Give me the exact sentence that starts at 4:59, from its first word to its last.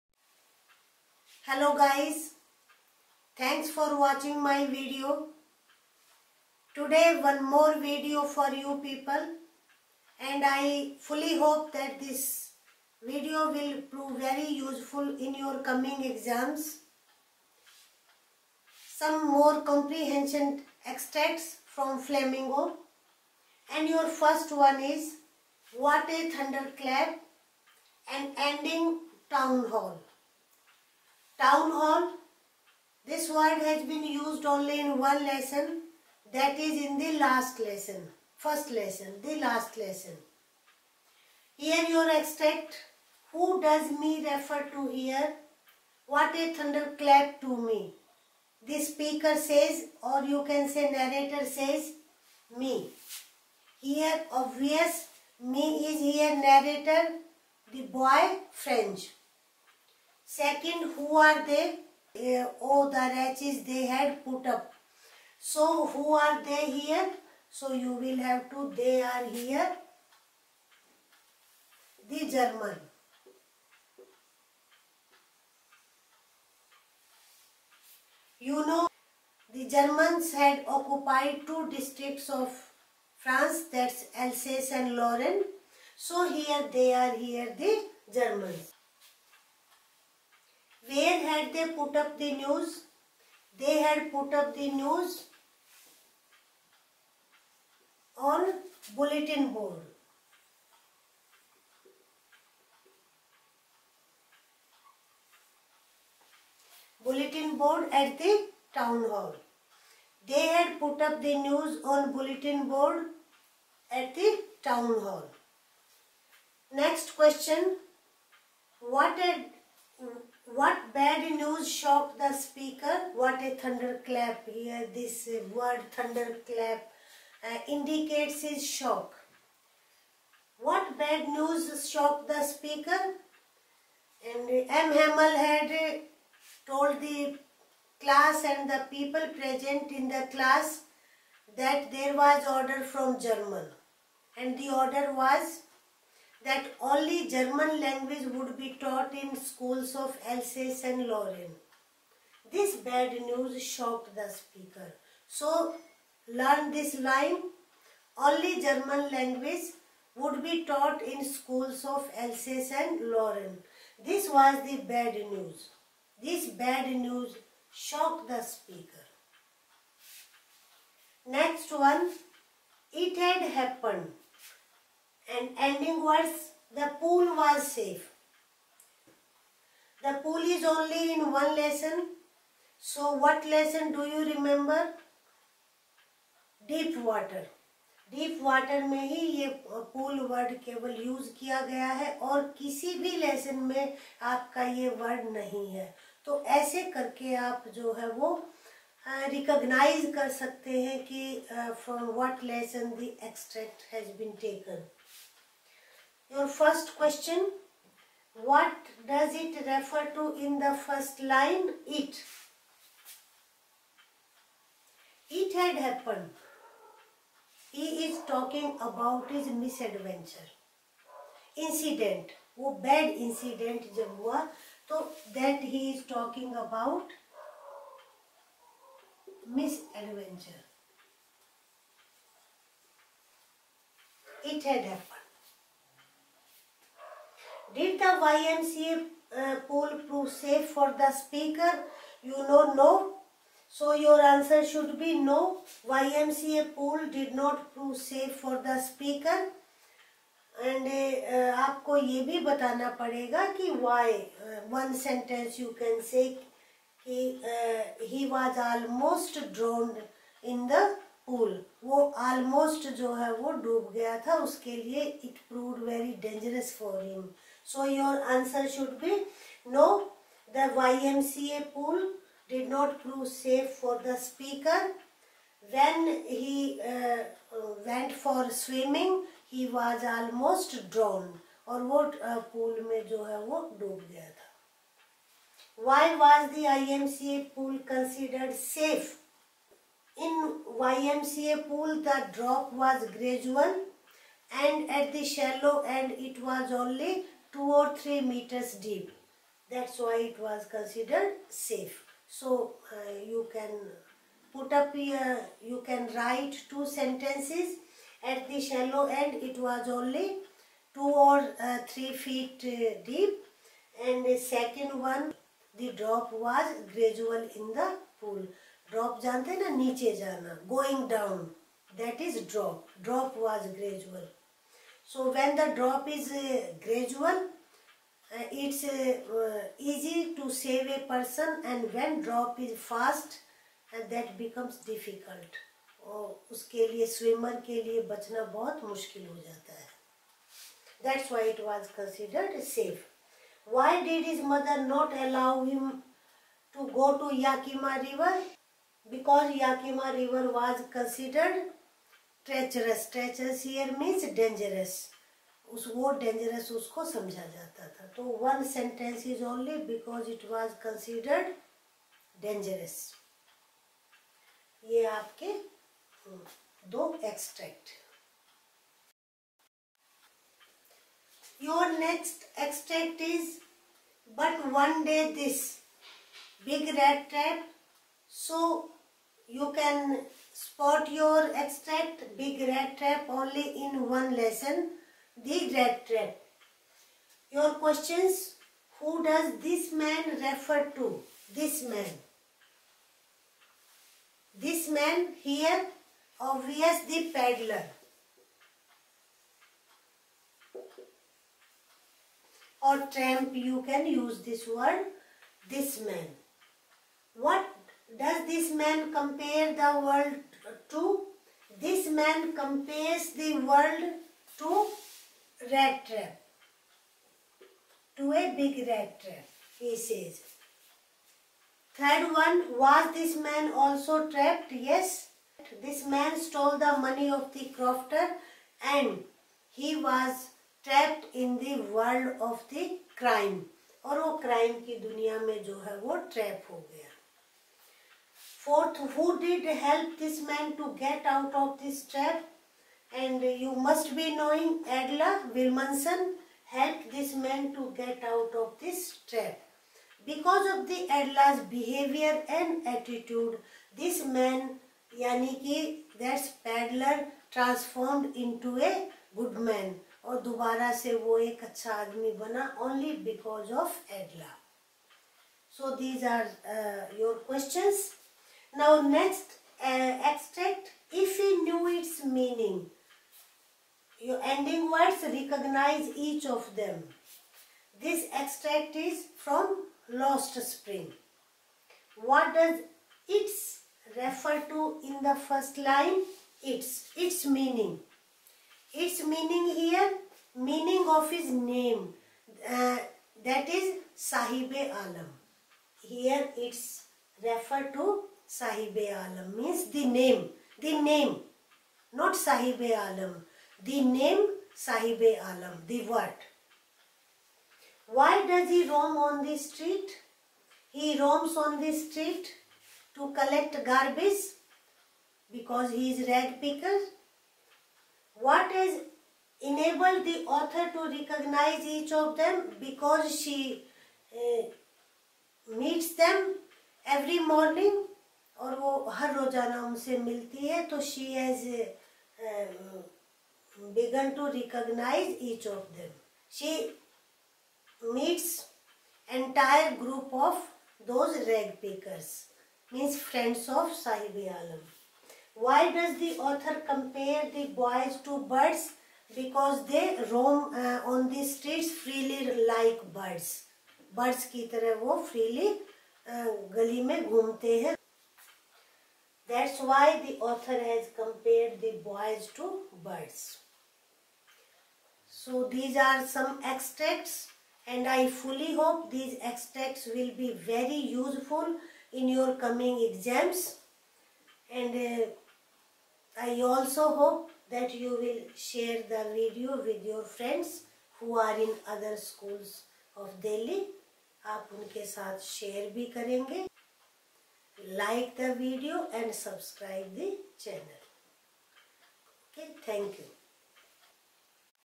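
That's why it was considered safe.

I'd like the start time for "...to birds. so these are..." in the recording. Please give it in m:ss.
9:22.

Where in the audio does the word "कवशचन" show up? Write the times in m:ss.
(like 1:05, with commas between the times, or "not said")
3:26, 7:47.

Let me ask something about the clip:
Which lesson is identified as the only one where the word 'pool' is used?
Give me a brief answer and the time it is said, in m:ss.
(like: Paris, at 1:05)
Deep Water, at 3:06.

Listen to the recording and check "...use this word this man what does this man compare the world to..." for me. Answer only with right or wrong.
right.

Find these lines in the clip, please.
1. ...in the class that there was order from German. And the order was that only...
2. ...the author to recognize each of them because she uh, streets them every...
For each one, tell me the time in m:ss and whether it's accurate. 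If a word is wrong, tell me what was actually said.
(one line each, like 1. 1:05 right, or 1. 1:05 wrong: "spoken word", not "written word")
1. 2:19 right
2. 8:40 wrong: "meets", not "streets".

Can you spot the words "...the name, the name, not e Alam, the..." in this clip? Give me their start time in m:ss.
8:19.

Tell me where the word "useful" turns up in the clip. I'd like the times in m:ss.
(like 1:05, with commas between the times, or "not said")
0:14, 9:31.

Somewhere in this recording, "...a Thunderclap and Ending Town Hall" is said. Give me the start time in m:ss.
0:26.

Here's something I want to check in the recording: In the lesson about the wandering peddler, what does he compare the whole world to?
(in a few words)
a big rat trap.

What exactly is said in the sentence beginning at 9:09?
Because they roam uh, on the streets freely like birds.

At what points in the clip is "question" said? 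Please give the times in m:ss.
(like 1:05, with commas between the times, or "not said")
1:57, 6:27.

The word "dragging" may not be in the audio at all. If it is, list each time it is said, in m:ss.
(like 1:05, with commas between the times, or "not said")
not said.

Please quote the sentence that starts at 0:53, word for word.
Here obvious me is here narrator, the boy French.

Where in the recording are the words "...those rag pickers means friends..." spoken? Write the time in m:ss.
9:01.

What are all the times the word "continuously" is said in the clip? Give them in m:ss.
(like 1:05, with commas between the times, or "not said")
not said.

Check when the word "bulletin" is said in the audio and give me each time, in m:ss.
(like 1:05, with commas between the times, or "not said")
1:38, 1:47, 1:52.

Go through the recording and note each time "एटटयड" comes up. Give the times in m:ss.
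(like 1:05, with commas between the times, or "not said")
7:32.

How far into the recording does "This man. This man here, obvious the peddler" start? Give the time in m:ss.
6:31.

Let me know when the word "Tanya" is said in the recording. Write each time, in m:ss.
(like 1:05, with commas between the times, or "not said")
not said.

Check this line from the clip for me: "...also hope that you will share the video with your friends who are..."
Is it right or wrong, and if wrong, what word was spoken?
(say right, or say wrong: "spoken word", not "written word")
right.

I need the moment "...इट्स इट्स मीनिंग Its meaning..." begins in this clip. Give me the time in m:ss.
8:06.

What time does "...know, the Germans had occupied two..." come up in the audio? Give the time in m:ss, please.
1:18.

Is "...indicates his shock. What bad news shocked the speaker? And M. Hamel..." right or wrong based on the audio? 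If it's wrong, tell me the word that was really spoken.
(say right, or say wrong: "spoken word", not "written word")
right.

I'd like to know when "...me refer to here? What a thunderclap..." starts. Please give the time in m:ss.
0:44.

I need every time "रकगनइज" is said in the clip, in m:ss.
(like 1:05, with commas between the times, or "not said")
3:19, 7:55.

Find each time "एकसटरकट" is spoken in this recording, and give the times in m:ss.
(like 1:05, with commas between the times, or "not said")
3:23, 6:07, 7:49, 7:58.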